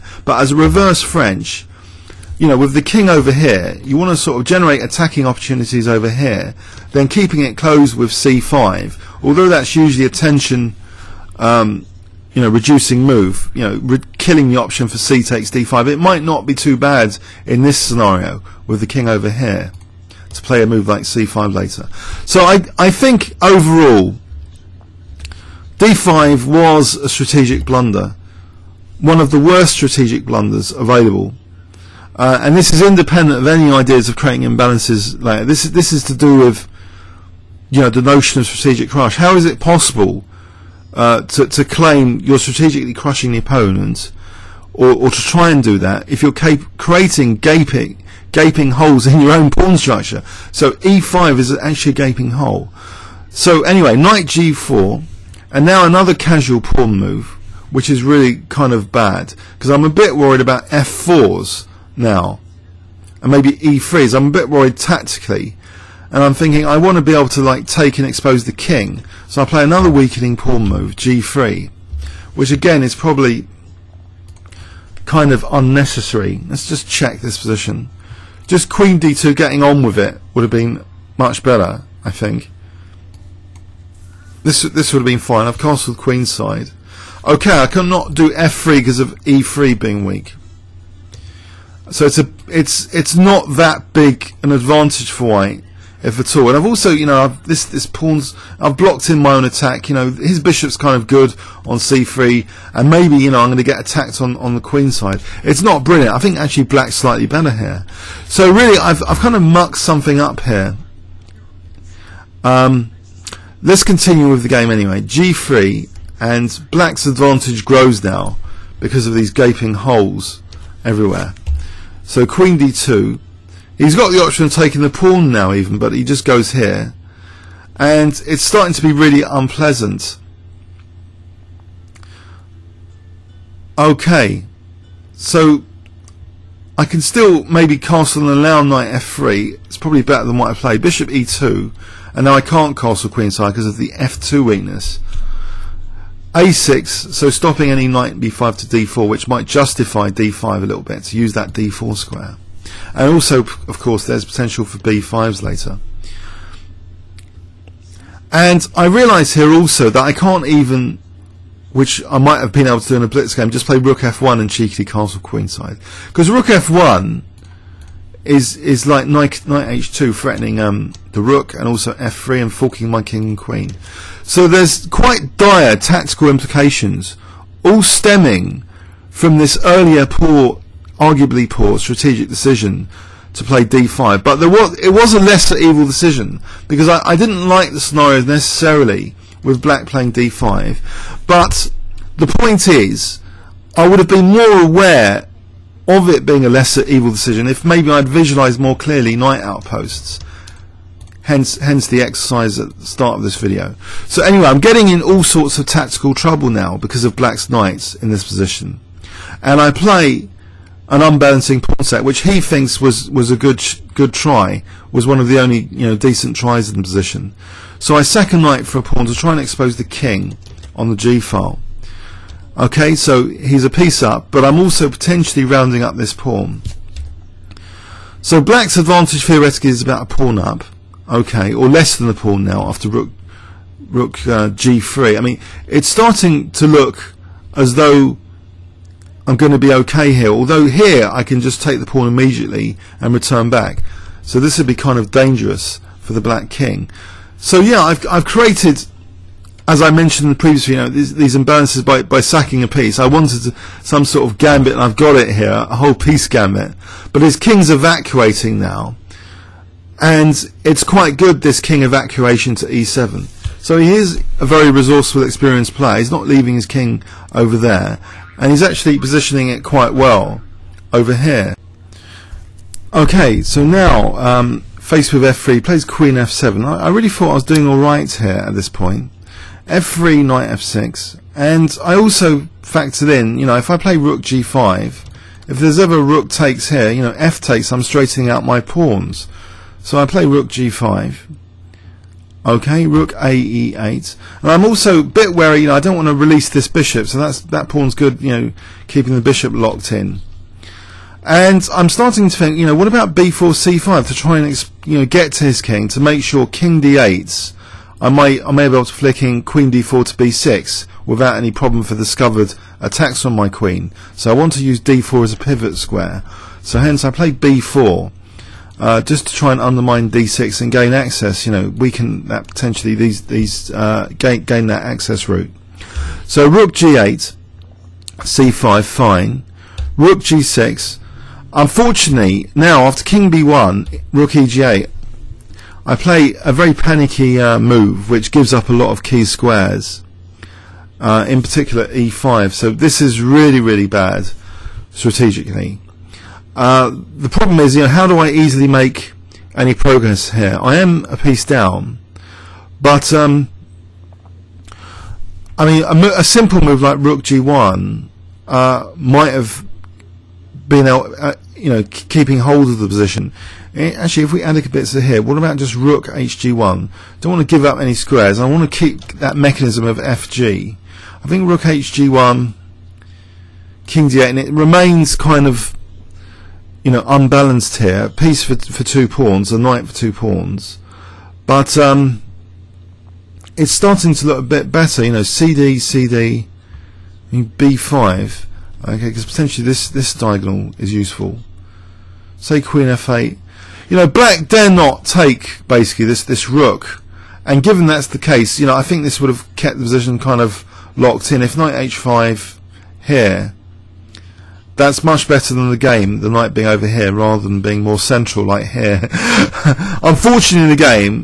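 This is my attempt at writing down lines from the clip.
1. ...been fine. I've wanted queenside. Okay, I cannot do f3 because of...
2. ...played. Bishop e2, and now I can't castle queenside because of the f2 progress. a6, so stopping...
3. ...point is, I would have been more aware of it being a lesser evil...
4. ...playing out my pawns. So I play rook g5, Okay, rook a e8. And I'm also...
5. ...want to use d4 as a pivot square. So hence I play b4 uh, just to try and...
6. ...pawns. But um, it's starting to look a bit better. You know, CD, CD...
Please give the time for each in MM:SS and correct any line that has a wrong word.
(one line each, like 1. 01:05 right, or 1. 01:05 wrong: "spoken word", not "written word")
1. 01:25 wrong: "castled", not "wanted"
2. 02:20 wrong: "weakness", not "progress"
3. 03:12 right
4. 04:47 wrong: "straightening", not "playing"
5. 05:14 right
6. 06:20 right.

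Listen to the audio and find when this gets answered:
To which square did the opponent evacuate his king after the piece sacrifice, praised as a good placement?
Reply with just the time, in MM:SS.
04:22.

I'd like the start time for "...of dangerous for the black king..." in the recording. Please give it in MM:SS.
04:04.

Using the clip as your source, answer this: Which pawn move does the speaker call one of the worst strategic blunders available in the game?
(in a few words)
d5.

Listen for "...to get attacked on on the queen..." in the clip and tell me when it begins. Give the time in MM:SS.
01:43.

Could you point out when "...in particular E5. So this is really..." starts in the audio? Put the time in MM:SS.
05:41.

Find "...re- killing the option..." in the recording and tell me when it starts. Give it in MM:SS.
00:13.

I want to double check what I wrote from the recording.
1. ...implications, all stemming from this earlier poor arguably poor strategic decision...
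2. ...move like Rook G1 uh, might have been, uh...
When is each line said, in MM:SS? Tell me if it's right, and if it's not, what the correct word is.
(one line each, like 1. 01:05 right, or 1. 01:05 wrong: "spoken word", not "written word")
1. 02:56 right
2. 05:56 right.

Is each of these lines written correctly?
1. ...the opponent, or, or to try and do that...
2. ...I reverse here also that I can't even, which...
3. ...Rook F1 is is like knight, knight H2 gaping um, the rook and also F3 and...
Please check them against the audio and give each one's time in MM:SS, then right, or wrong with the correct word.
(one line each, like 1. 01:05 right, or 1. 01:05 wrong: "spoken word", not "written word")
1. 00:43 right
2. 02:38 wrong: "realise", not "reverse"
3. 02:46 wrong: "threatening", not "gaping".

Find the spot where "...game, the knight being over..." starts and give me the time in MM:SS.
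06:45.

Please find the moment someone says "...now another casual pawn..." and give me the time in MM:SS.
00:55.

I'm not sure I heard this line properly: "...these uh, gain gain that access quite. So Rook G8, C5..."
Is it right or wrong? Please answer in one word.
wrong.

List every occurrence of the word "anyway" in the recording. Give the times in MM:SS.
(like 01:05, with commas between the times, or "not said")
00:53, 01:54, 03:24.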